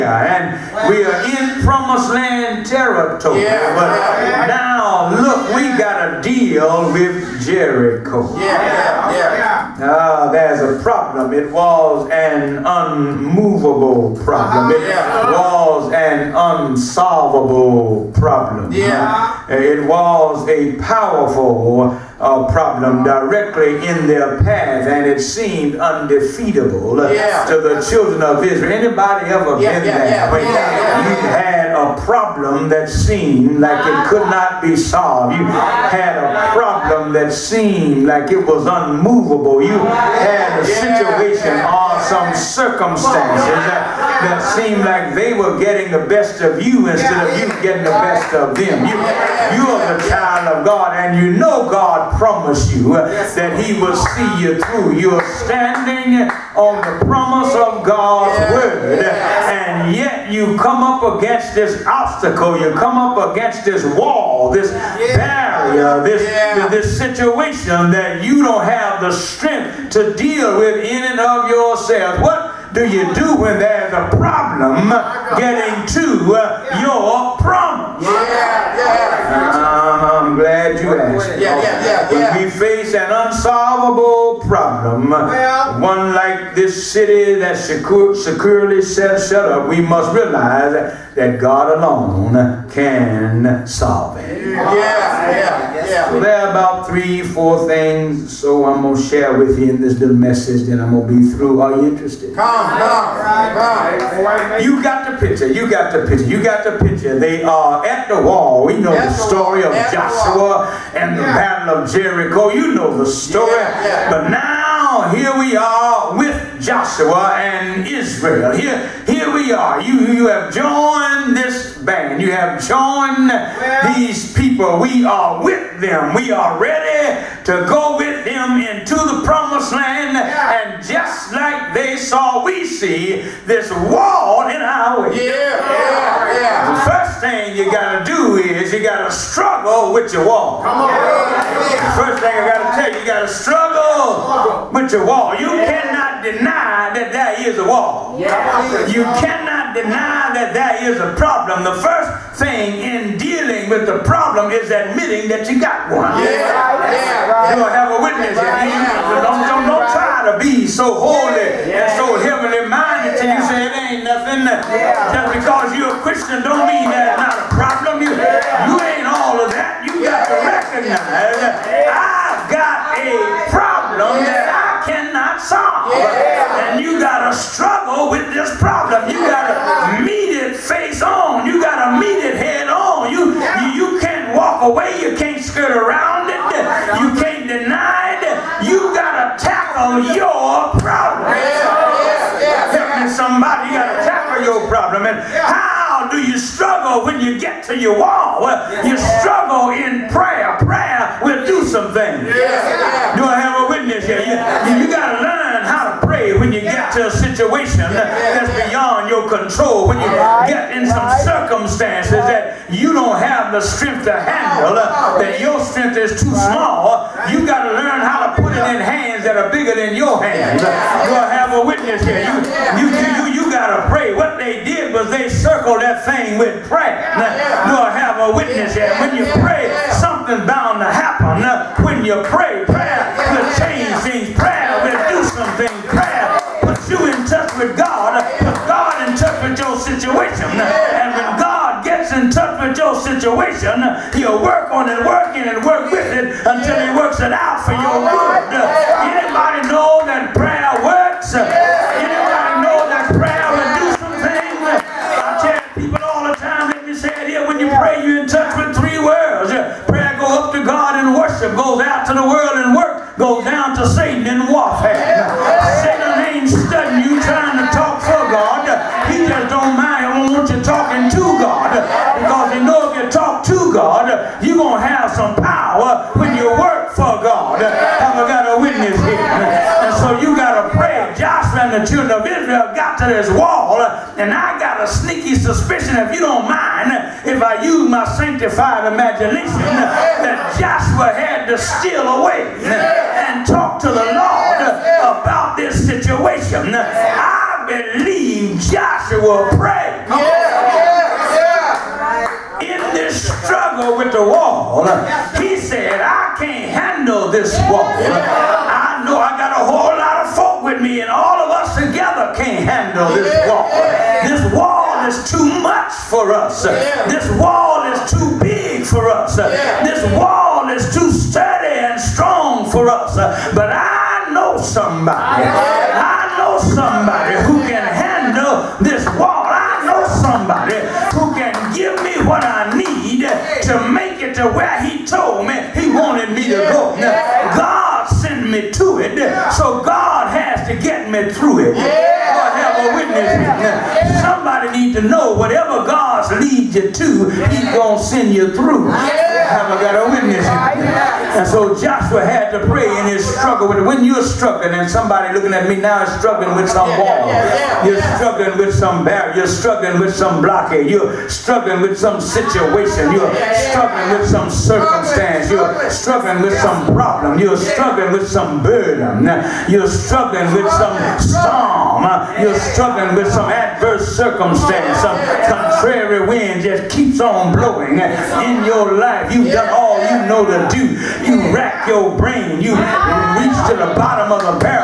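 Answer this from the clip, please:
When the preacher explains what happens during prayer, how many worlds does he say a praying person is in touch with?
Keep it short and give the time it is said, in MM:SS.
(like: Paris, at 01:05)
3, at 04:18.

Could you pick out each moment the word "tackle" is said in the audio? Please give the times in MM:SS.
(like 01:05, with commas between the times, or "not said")
03:09, 03:14.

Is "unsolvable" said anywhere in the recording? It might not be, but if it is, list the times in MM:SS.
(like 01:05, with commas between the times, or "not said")
00:16, 01:23.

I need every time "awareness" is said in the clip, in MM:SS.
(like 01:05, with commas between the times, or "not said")
not said.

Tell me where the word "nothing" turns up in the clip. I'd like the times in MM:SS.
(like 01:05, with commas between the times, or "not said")
02:44.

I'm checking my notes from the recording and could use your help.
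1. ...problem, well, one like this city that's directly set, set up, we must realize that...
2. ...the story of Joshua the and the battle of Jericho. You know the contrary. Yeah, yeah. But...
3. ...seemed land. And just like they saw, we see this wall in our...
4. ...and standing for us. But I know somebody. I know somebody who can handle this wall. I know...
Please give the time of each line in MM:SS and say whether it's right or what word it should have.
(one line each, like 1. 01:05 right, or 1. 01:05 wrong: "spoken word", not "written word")
1. 01:24 wrong: "securely", not "directly"
2. 01:49 wrong: "story", not "contrary"
3. 02:09 wrong: "promised", not "seemed"
4. 05:21 wrong: "strong", not "standing".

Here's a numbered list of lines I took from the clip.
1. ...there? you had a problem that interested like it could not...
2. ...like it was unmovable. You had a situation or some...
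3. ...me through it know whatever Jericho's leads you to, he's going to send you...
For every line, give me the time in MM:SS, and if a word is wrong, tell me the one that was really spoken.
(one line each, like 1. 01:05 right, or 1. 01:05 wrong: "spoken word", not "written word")
1. 00:30 wrong: "seemed", not "interested"
2. 00:38 right
3. 05:41 wrong: "God", not "Jericho".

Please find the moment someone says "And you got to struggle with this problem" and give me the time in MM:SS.
02:55.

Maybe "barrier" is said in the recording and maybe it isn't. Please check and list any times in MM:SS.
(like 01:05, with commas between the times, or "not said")
01:04, 05:59.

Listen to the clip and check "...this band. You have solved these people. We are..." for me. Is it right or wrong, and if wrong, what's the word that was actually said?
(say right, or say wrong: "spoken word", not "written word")
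wrong: "joined", not "solved".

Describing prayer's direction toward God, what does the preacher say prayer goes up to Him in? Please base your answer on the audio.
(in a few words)
worship.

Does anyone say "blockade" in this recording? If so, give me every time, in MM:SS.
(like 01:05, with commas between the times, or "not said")
06:00.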